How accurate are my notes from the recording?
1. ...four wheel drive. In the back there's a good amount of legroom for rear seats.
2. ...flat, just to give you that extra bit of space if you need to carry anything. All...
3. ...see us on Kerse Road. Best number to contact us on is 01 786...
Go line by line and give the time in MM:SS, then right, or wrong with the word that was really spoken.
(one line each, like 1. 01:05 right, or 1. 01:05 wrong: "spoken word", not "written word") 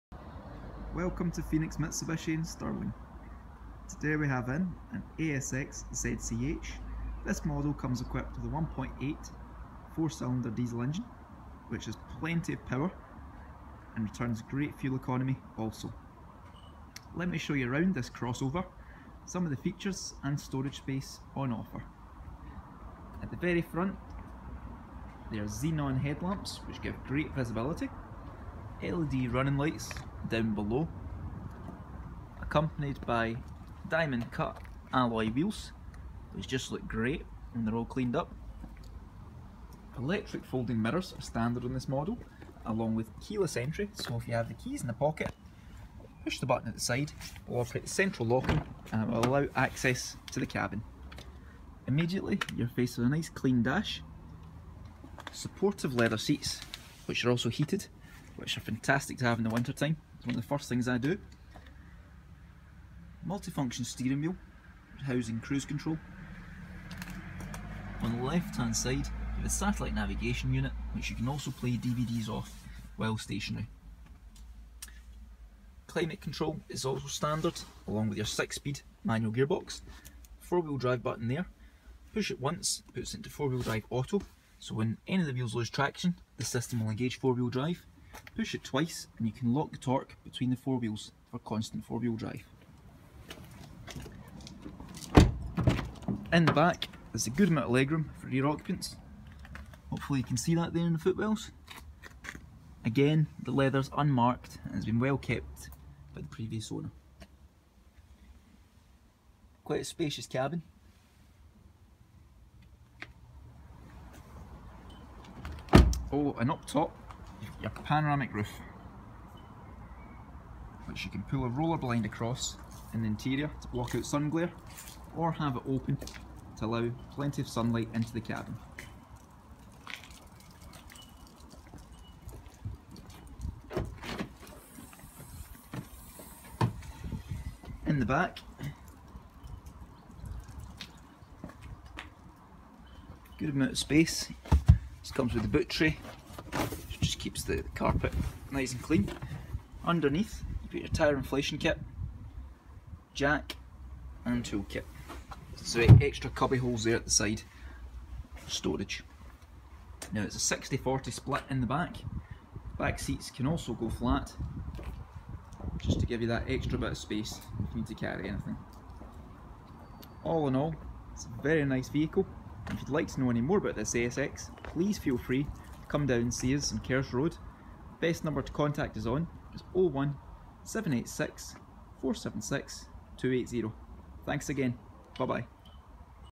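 1. 01:31 wrong: "occupants", not "seats"
2. 02:43 right
3. 02:56 right.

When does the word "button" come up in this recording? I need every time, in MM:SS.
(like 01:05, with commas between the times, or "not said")
00:46, 01:21.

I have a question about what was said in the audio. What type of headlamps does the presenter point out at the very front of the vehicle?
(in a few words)
Xenon.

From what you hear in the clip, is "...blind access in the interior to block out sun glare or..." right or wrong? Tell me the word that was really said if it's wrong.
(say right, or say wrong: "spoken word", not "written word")
wrong: "across", not "access".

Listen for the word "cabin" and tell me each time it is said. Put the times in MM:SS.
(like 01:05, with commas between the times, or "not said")
00:50, 01:50, 02:08.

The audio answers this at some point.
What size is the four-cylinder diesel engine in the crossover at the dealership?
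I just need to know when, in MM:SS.
00:08.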